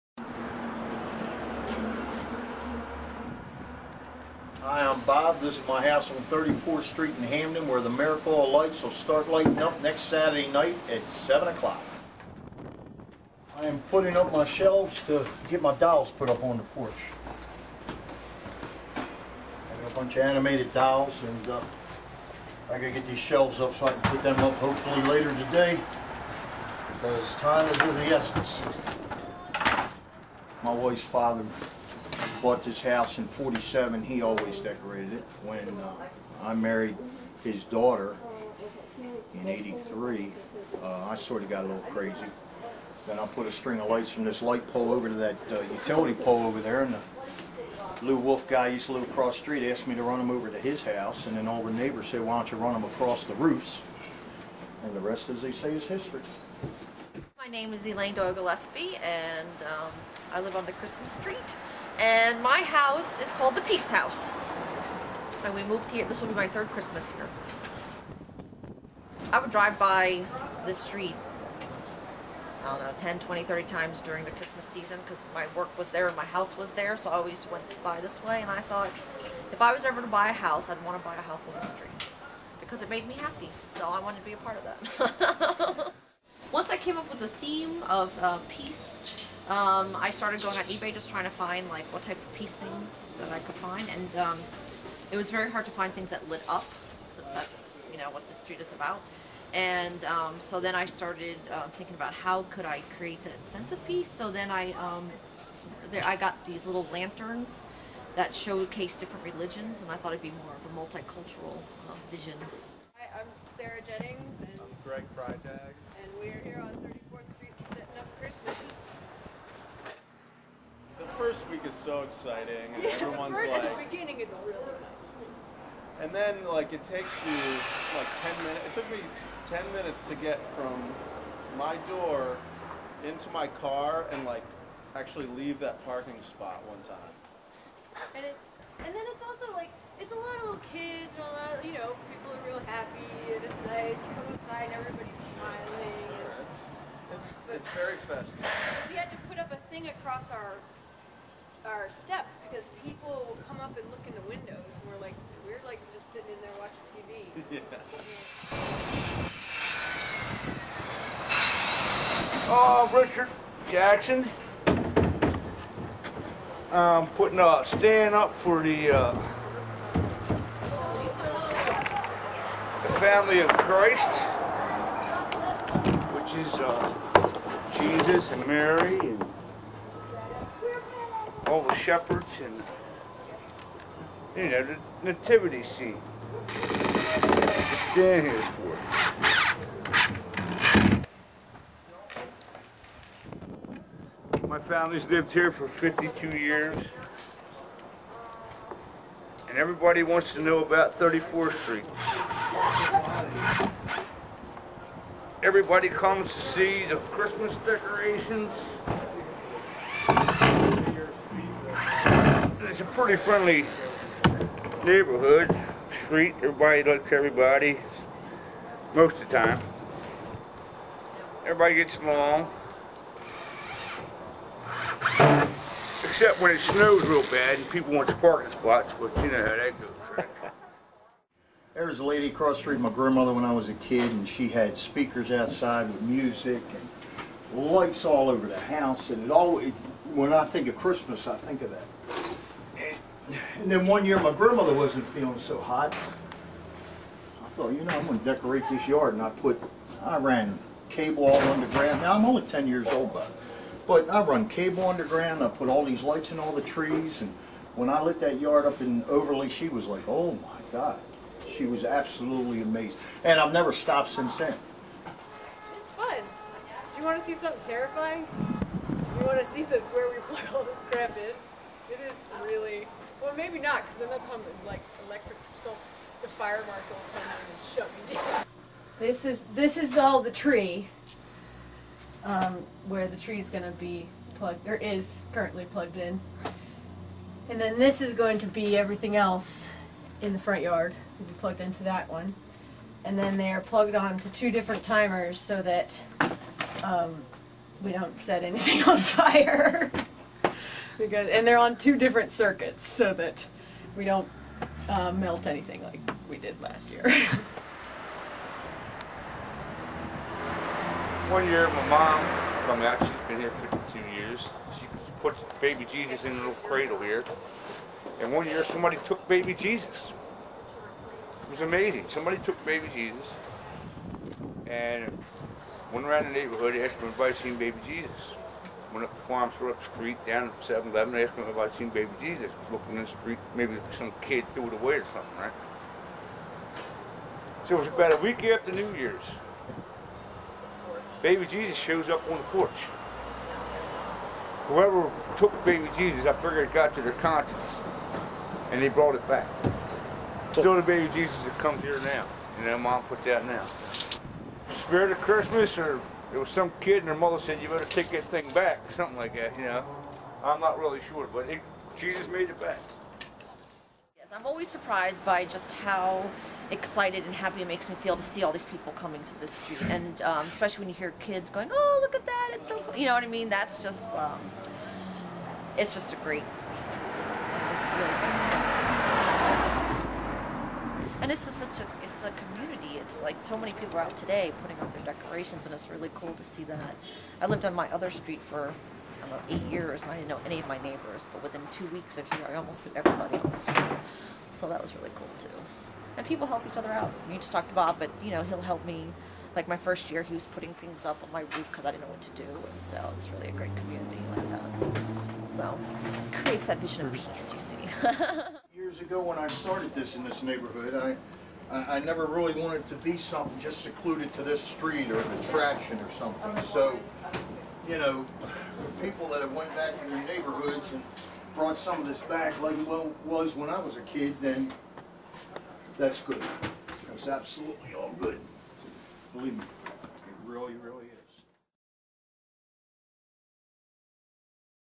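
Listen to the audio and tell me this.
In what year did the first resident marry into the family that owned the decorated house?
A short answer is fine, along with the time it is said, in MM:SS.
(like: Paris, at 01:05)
1983, at 00:39.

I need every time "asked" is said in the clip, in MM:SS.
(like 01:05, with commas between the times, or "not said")
00:49, 05:31.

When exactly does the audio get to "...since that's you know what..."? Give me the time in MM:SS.
01:37.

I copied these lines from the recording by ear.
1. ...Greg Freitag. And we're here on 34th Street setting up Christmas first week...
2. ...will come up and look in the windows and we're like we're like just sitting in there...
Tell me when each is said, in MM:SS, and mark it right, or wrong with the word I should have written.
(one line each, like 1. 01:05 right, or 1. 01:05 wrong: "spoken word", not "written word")
1. 01:54 right
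2. 02:33 right.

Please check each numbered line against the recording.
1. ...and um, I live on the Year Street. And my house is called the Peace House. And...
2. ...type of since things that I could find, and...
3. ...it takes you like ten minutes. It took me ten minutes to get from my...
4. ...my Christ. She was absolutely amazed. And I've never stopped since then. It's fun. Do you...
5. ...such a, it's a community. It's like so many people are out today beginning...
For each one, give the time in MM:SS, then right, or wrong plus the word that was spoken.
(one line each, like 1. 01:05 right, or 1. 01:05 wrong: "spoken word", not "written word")
1. 00:59 wrong: "Christmas", not "Year"
2. 01:32 wrong: "peace", not "since"
3. 02:06 right
4. 04:20 wrong: "God", not "Christ"
5. 06:21 wrong: "putting", not "beginning".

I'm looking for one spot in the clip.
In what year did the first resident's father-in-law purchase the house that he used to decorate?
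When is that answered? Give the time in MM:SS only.
00:33.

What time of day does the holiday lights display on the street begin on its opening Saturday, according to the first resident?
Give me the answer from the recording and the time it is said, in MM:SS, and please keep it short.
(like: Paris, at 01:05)
7 o'clock, at 00:11.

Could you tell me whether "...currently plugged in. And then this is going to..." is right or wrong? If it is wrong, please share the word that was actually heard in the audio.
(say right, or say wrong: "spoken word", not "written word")
right.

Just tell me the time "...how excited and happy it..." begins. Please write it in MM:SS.
06:05.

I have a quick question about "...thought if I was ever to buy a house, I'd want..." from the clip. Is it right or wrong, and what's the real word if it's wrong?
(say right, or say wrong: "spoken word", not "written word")
right.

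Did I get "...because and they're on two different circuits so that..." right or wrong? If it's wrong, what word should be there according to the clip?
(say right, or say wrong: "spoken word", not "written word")
right.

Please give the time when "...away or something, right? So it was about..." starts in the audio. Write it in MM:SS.
05:34.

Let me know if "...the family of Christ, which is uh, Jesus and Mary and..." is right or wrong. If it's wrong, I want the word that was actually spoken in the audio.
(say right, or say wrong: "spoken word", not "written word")
right.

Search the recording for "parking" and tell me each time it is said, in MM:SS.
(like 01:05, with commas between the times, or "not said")
02:15, 03:48.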